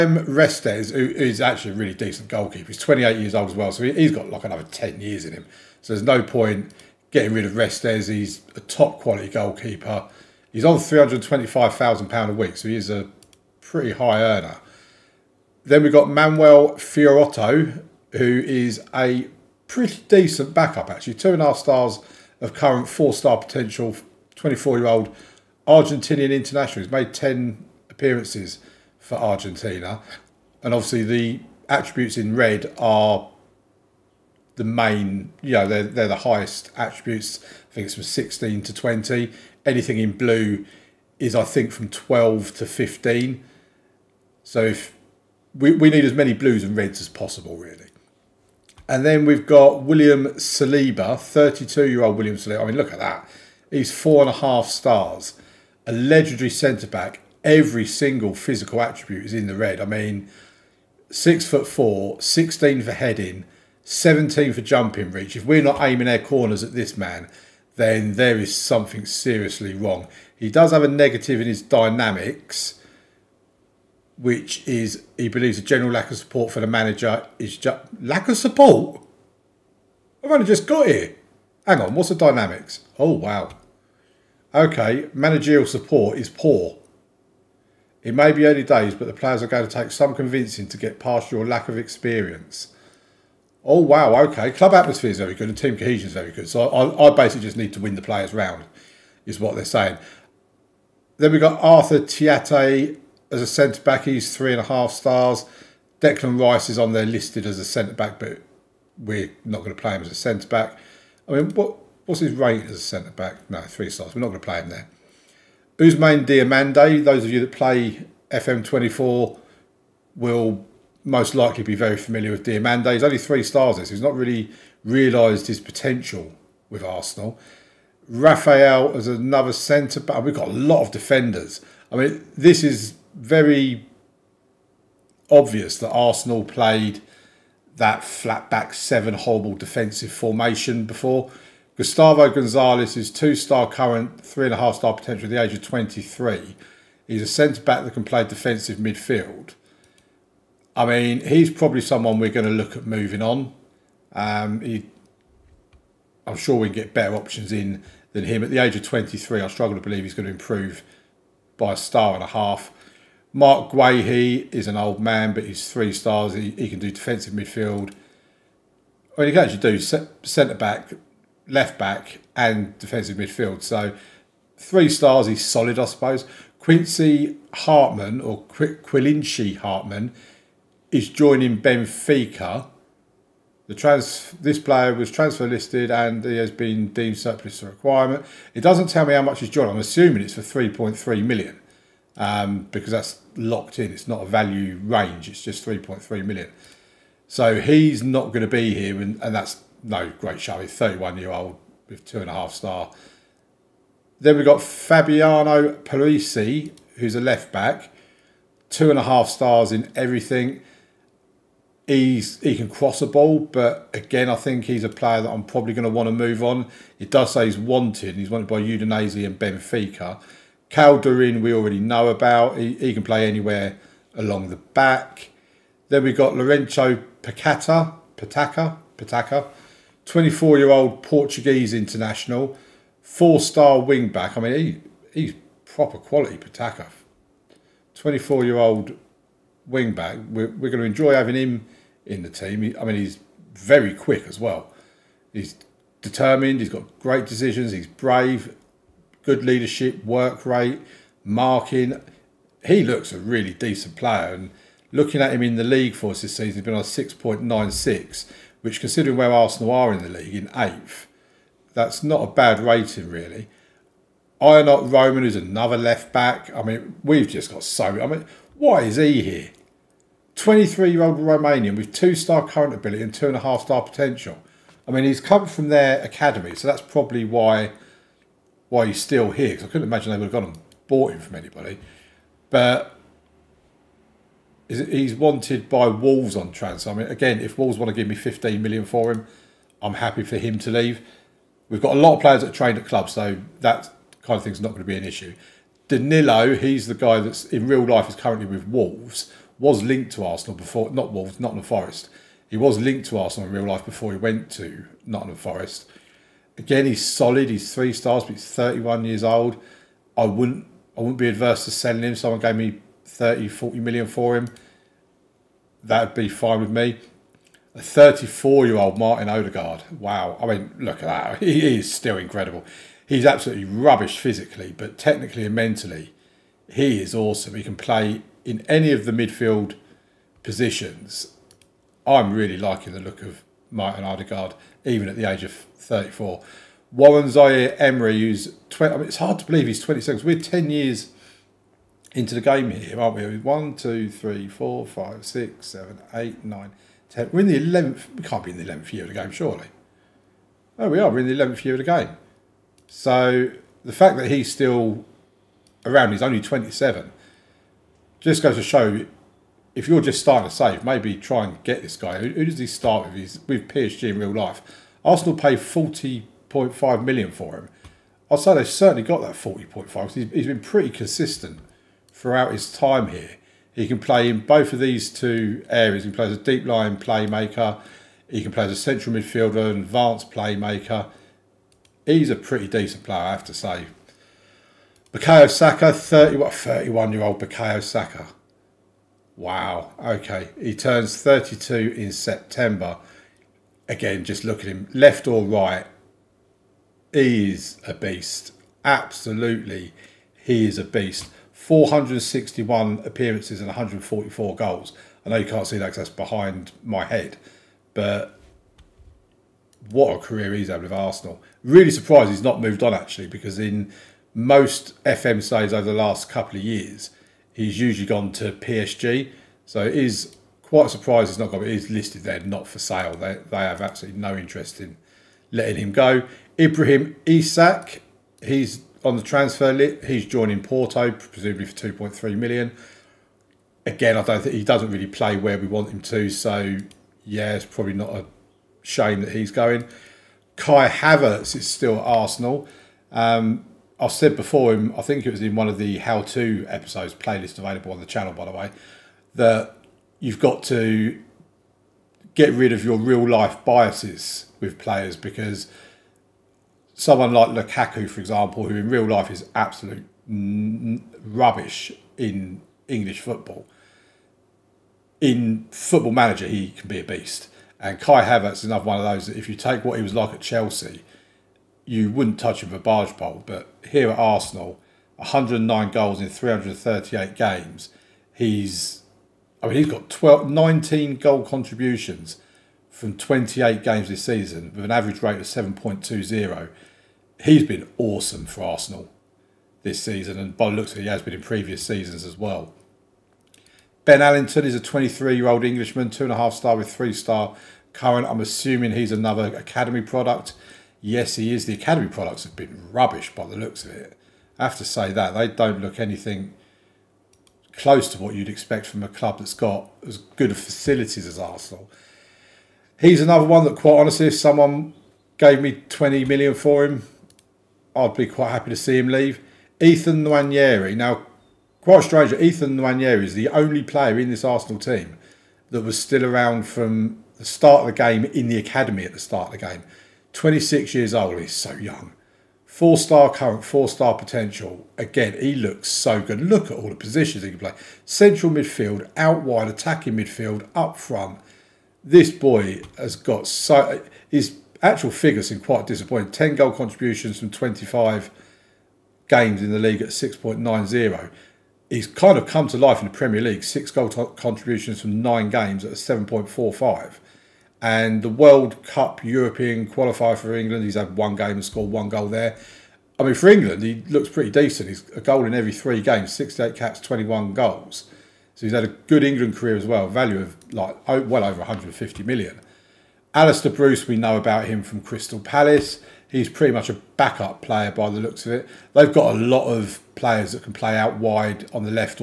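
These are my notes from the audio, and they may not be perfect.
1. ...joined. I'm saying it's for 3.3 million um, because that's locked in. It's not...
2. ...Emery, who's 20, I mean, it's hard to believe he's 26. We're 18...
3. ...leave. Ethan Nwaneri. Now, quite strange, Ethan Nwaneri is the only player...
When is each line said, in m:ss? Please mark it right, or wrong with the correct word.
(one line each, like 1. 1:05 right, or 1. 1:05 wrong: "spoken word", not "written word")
1. 3:09 wrong: "assuming", not "saying"
2. 5:37 wrong: "10", not "18"
3. 8:39 right.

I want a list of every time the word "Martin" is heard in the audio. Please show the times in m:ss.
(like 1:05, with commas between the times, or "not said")
5:18, 5:33.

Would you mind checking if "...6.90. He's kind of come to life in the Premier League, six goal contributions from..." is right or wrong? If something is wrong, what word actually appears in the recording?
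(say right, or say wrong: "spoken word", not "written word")
right.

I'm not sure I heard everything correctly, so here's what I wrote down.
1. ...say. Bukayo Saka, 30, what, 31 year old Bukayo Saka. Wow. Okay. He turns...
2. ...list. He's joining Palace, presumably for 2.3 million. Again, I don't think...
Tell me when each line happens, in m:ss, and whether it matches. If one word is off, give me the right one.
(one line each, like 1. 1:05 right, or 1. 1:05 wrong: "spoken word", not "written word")
1. 6:23 right
2. 7:09 wrong: "Porto", not "Palace".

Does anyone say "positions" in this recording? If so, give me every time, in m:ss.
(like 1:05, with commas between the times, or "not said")
5:30, 8:56.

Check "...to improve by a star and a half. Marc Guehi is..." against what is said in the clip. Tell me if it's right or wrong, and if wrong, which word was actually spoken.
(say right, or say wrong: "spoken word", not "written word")
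right.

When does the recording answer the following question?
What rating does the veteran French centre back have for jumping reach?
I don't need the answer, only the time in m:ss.
1:03.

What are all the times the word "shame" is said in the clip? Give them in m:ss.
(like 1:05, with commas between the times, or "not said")
7:18.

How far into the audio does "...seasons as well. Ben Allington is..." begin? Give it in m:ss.
8:11.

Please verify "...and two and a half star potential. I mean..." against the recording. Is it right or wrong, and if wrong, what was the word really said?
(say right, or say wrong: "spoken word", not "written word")
right.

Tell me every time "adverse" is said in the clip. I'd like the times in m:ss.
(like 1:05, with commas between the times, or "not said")
5:11.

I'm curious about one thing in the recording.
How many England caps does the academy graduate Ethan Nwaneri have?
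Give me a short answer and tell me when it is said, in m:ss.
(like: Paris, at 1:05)
68, at 9:26.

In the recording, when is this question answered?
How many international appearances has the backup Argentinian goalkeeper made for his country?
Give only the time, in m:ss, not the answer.
0:26.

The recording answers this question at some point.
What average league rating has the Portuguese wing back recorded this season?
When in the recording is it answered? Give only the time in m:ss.
4:16.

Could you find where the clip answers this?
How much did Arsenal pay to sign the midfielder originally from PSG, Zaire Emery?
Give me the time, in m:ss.
6:05.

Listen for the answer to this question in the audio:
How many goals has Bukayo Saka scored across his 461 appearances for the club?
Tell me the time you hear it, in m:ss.
6:43.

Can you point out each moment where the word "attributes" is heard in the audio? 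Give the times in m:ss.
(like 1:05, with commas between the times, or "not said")
0:31, 0:36, 0:58.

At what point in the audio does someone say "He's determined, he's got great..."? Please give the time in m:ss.
4:05.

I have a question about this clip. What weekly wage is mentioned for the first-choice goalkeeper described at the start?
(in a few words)
£325,000.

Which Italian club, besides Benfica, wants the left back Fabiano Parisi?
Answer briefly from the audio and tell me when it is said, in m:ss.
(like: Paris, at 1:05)
Udinese, at 3:38.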